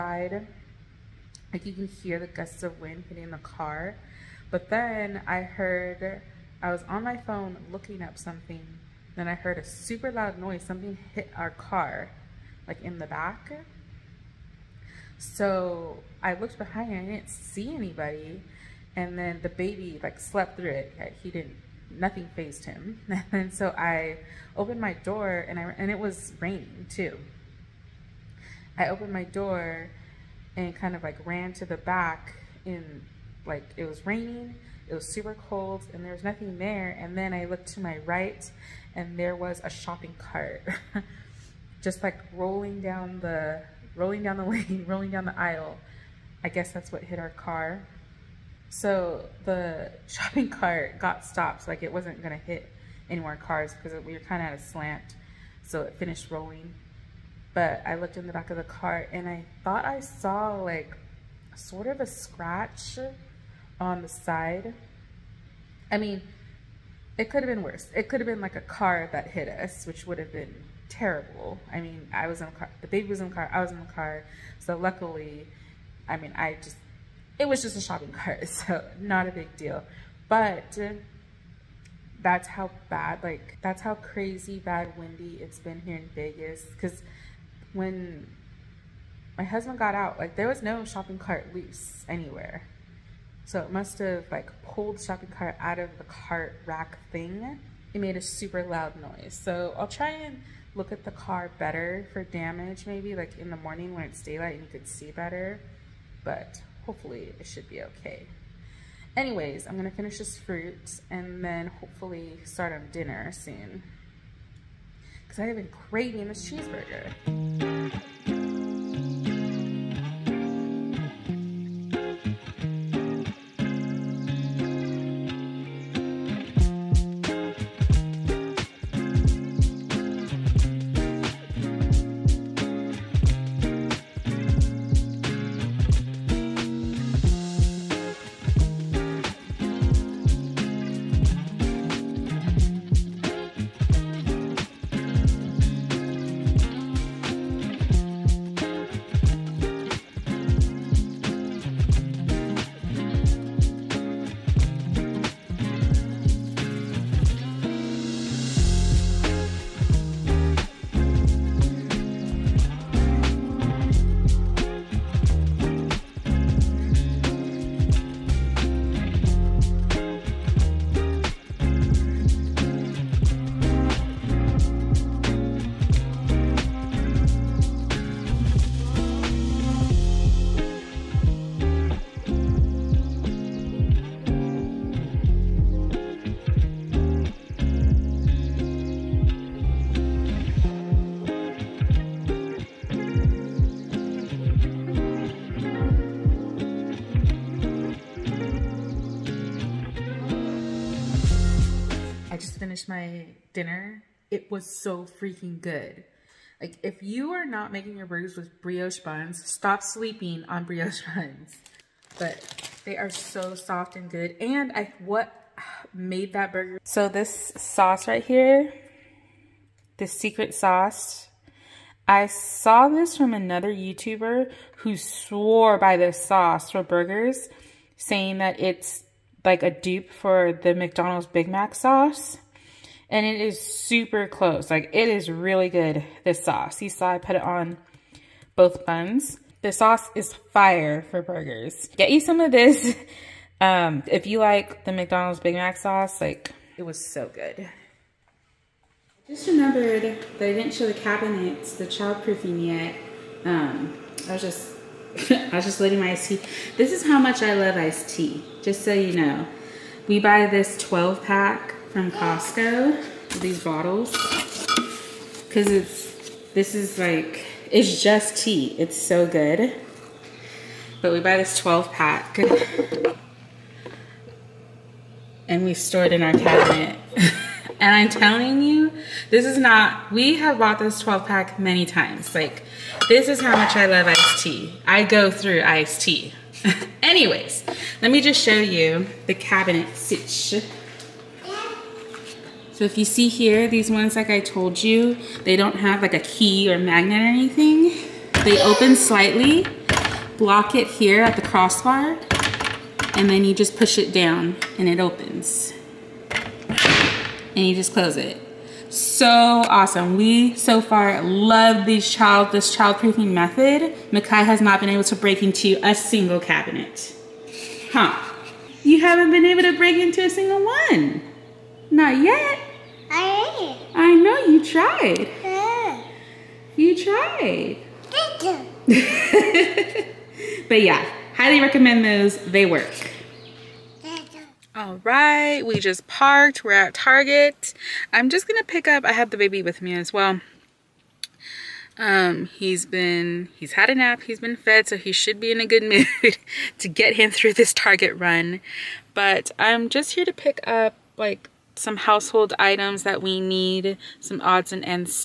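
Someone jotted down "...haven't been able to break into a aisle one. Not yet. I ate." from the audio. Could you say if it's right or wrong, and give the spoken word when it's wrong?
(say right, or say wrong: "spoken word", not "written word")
wrong: "single", not "aisle".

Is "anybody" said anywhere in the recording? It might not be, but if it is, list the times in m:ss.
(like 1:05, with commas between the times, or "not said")
0:17.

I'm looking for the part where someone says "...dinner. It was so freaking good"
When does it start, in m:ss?
3:23.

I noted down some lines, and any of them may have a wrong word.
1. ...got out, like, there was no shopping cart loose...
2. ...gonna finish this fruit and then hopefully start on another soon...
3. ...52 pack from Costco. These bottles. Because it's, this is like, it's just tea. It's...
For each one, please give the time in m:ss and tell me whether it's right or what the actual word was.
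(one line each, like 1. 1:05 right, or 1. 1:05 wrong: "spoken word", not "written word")
1. 1:29 right
2. 1:49 wrong: "dinner", not "another"
3. 4:20 wrong: "12", not "52".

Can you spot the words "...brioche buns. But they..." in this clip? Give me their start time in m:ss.
3:30.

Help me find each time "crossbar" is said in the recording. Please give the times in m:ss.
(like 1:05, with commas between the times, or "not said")
5:01.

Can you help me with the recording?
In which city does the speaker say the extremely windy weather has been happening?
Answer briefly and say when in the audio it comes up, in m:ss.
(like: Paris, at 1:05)
Vegas, at 1:26.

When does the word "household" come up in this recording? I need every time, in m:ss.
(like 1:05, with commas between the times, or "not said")
5:51.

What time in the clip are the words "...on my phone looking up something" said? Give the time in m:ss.
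0:06.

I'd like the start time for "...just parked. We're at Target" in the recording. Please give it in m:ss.
5:35.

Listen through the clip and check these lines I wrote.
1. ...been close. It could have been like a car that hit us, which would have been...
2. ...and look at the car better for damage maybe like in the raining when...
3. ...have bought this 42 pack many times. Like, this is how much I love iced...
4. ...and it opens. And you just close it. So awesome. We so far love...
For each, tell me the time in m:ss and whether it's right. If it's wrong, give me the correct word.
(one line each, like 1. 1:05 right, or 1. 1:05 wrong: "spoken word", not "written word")
1. 1:07 wrong: "worse", not "close"
2. 1:40 wrong: "morning", not "raining"
3. 4:40 wrong: "12", not "42"
4. 5:04 right.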